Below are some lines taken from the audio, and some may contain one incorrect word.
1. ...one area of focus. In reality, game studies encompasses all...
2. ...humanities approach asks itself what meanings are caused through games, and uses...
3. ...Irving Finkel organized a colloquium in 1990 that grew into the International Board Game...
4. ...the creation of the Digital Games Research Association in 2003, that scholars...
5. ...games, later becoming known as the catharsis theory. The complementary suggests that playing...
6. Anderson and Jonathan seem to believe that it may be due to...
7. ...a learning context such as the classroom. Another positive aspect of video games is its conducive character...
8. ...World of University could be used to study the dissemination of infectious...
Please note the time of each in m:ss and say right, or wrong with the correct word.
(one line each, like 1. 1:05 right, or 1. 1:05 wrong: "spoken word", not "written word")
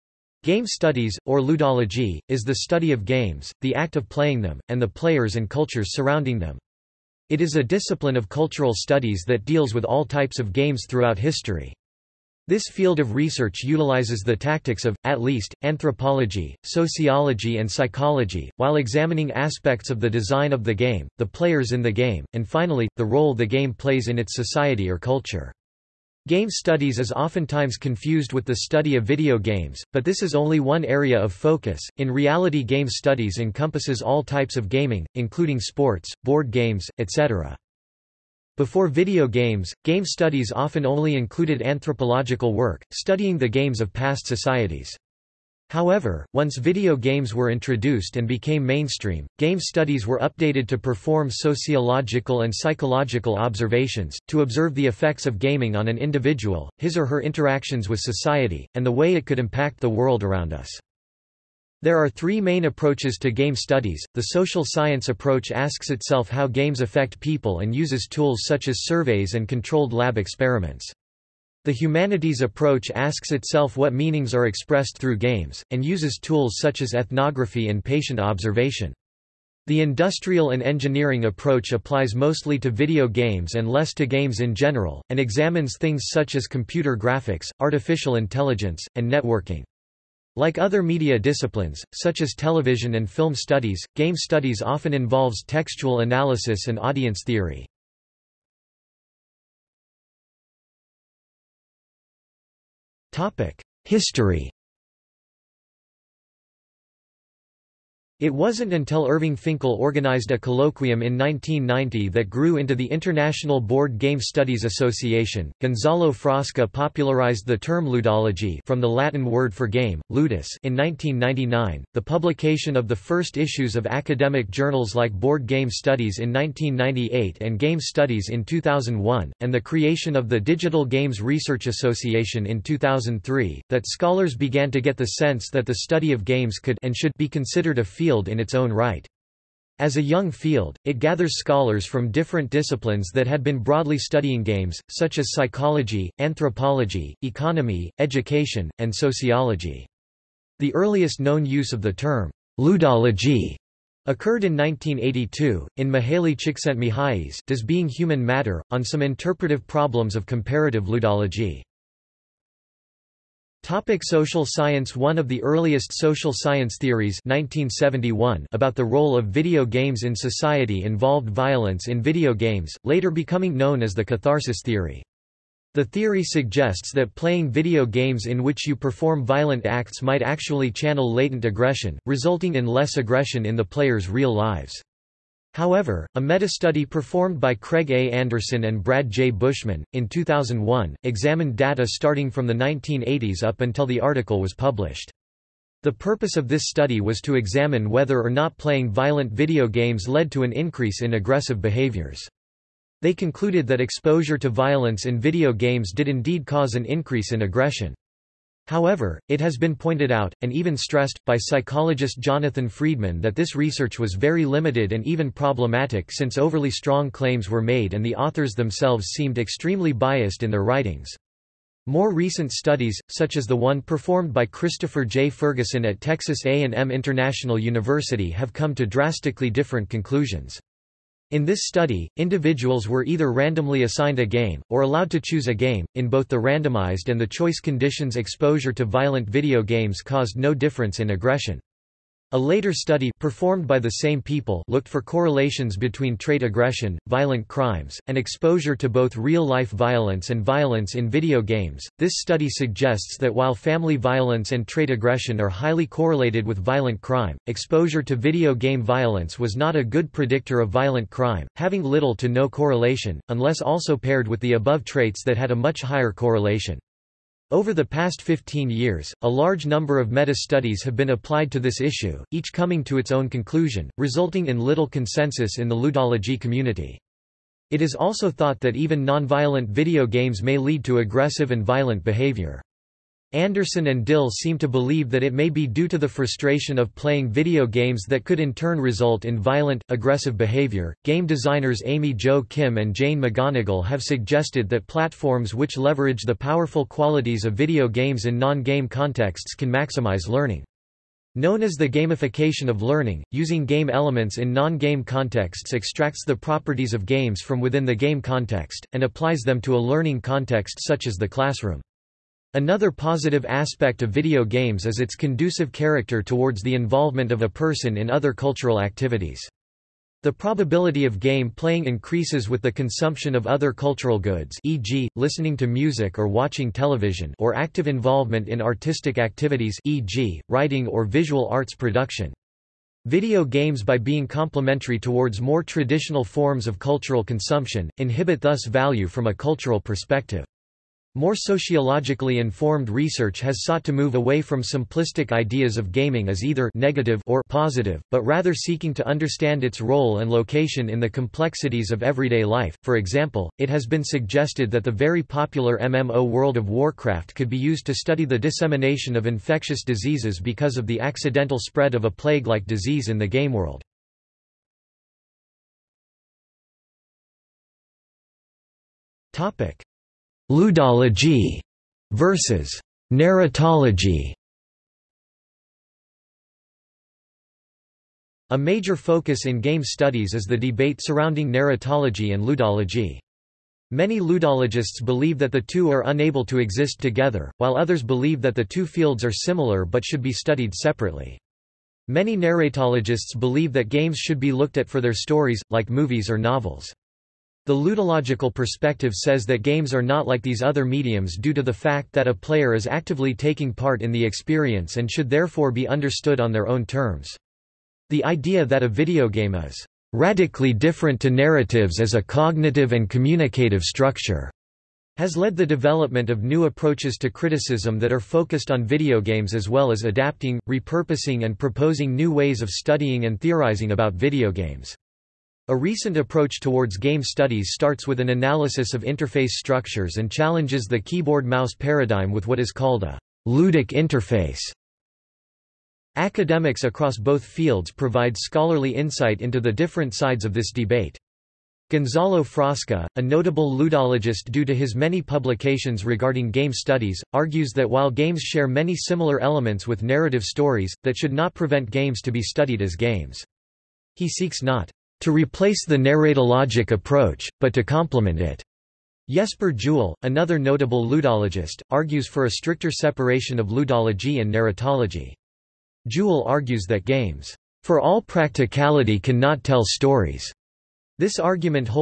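1. 0:30 right
2. 1:11 wrong: "expressed", not "caused"
3. 1:49 right
4. 2:09 right
5. 2:52 wrong: "theory", not "complementary"
6. 4:43 wrong: "Dill", not "Jonathan"
7. 5:09 right
8. 5:56 wrong: "Warcraft", not "University".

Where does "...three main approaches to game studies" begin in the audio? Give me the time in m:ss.
1:02.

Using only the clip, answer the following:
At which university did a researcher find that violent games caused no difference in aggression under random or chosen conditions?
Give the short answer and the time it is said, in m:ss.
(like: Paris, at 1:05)
Texas A&M International University, at 3:46.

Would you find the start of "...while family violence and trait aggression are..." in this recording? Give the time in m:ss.
4:13.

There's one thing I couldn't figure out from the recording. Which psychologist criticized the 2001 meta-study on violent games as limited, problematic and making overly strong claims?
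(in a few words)
Jonathan Freedman.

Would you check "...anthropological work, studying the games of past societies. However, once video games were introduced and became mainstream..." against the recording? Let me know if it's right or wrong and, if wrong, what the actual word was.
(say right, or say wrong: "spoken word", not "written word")
right.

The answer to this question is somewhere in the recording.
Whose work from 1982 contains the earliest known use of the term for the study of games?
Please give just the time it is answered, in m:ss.
2:35.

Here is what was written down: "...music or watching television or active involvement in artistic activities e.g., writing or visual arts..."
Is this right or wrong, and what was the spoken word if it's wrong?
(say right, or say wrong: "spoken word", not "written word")
right.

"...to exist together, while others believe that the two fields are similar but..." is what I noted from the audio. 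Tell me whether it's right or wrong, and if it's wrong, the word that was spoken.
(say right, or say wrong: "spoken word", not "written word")
right.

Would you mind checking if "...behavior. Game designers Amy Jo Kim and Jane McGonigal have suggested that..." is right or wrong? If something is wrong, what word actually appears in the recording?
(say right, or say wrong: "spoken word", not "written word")
right.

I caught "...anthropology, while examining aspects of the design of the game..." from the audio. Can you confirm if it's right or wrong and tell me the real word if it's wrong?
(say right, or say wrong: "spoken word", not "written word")
wrong: "psychology", not "anthropology".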